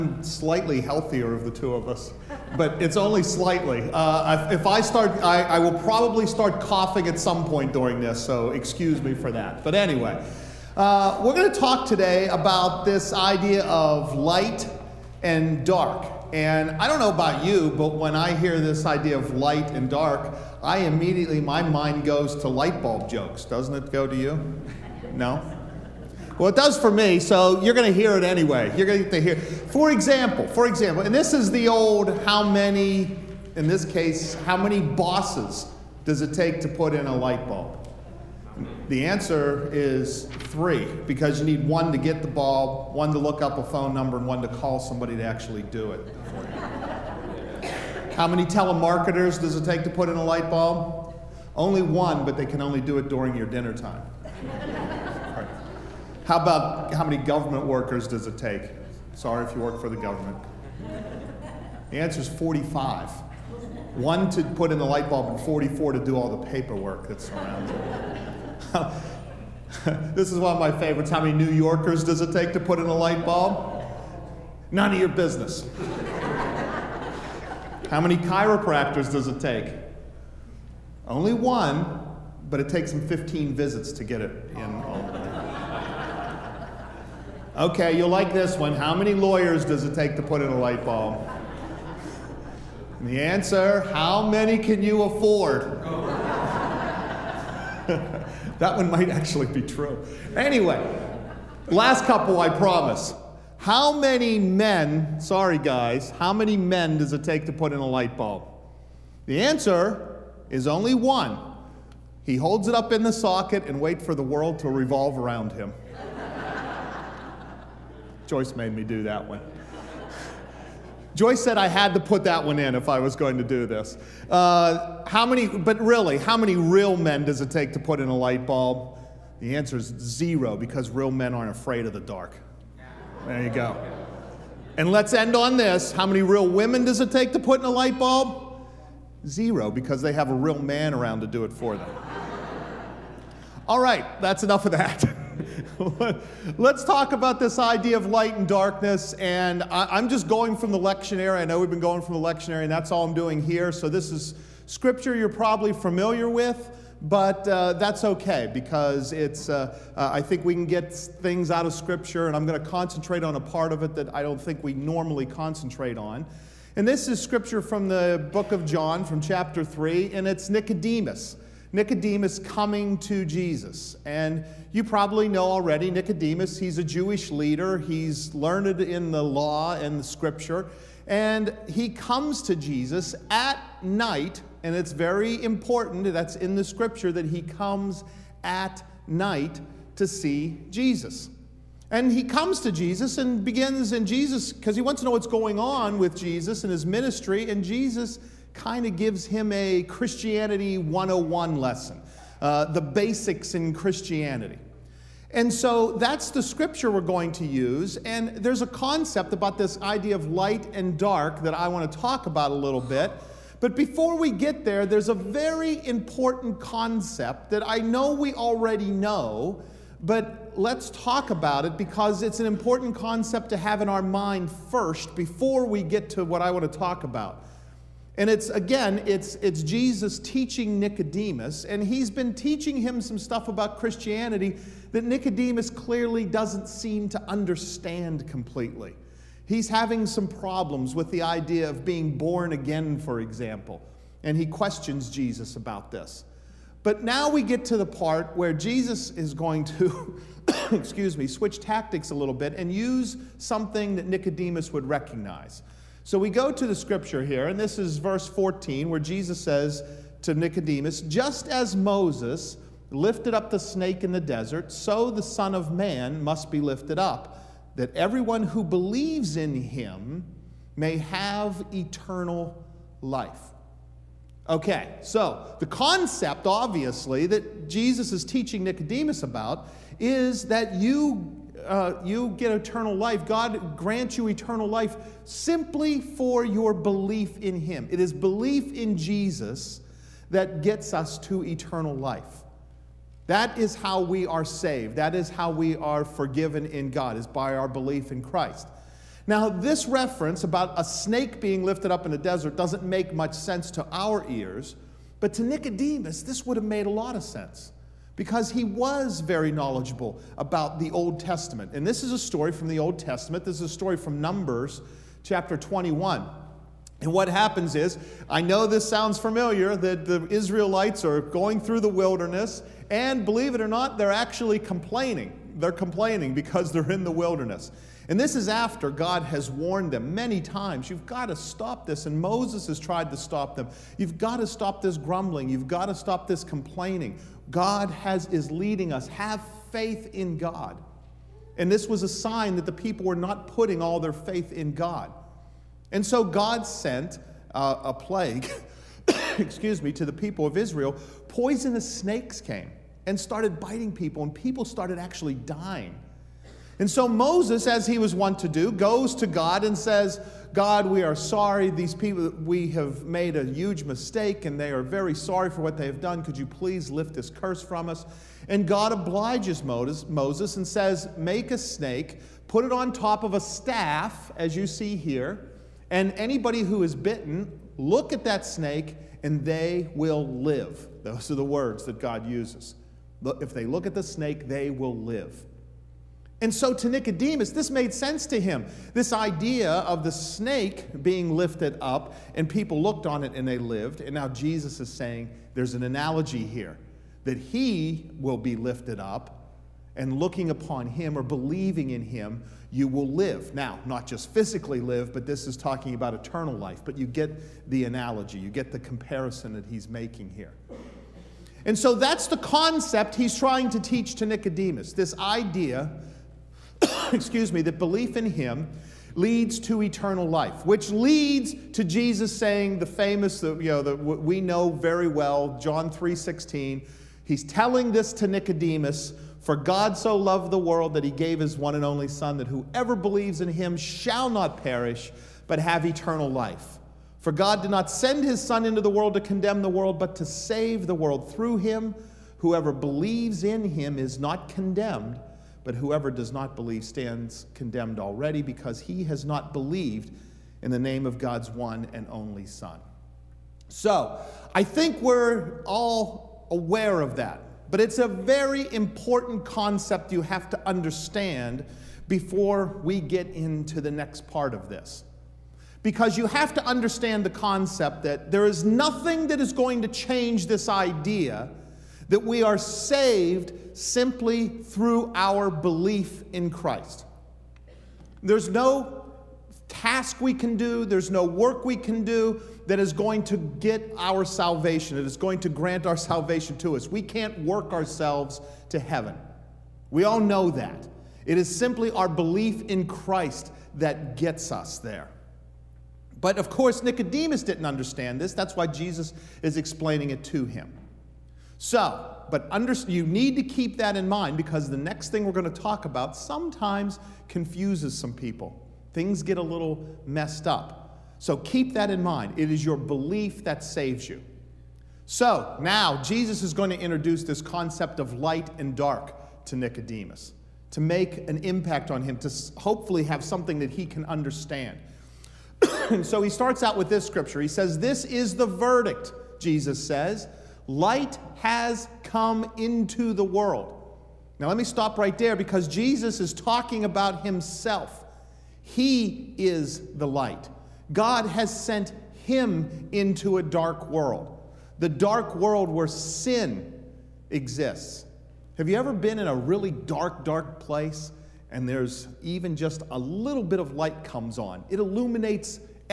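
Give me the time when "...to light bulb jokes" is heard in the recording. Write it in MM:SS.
00:22.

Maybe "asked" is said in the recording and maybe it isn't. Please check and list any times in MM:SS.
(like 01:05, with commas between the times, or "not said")
not said.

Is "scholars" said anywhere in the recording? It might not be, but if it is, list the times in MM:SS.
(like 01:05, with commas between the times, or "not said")
not said.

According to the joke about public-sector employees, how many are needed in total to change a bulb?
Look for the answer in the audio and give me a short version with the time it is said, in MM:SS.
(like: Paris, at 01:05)
45, at 01:02.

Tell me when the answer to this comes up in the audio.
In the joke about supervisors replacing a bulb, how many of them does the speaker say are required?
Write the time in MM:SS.
00:40.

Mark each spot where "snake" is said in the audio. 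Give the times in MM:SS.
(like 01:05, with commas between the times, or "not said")
04:23, 05:00, 05:51, 06:11, 06:18, 06:24, 06:30.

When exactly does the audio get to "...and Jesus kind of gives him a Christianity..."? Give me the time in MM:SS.
03:17.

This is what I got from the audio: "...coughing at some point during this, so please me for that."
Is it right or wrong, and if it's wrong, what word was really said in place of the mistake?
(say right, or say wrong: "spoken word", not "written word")
wrong: "excuse", not "please".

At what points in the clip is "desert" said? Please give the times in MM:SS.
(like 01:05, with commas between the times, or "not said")
04:24, 05:02.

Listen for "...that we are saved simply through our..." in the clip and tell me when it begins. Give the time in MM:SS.
07:52.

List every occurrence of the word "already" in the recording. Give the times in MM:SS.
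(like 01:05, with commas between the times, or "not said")
02:55, 03:38, 07:27.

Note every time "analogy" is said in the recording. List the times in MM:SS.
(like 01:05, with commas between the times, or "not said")
06:35, 06:47.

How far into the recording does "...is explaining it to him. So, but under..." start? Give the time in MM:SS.
08:19.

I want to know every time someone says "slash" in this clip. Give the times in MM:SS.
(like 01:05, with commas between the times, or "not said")
not said.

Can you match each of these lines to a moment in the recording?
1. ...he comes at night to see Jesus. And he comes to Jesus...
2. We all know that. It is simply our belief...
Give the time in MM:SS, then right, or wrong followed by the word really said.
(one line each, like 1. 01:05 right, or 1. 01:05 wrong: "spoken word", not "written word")
1. 03:07 right
2. 08:09 right.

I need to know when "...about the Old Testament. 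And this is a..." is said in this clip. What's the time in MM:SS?
05:10.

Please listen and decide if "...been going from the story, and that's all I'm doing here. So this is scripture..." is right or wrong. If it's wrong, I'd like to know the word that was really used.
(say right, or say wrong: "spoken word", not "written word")
wrong: "lectionary", not "story".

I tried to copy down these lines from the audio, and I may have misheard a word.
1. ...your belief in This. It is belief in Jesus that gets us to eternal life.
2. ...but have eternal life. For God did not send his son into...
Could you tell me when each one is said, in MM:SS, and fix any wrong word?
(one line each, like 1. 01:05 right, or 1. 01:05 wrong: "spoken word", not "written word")
1. 04:46 wrong: "Him", not "This"
2. 07:15 right.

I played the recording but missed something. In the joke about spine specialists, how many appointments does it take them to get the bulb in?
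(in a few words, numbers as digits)
15.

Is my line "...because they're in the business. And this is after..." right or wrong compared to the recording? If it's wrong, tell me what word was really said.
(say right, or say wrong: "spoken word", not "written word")
wrong: "wilderness", not "business".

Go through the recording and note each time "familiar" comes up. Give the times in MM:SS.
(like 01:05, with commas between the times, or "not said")
02:35, 05:19.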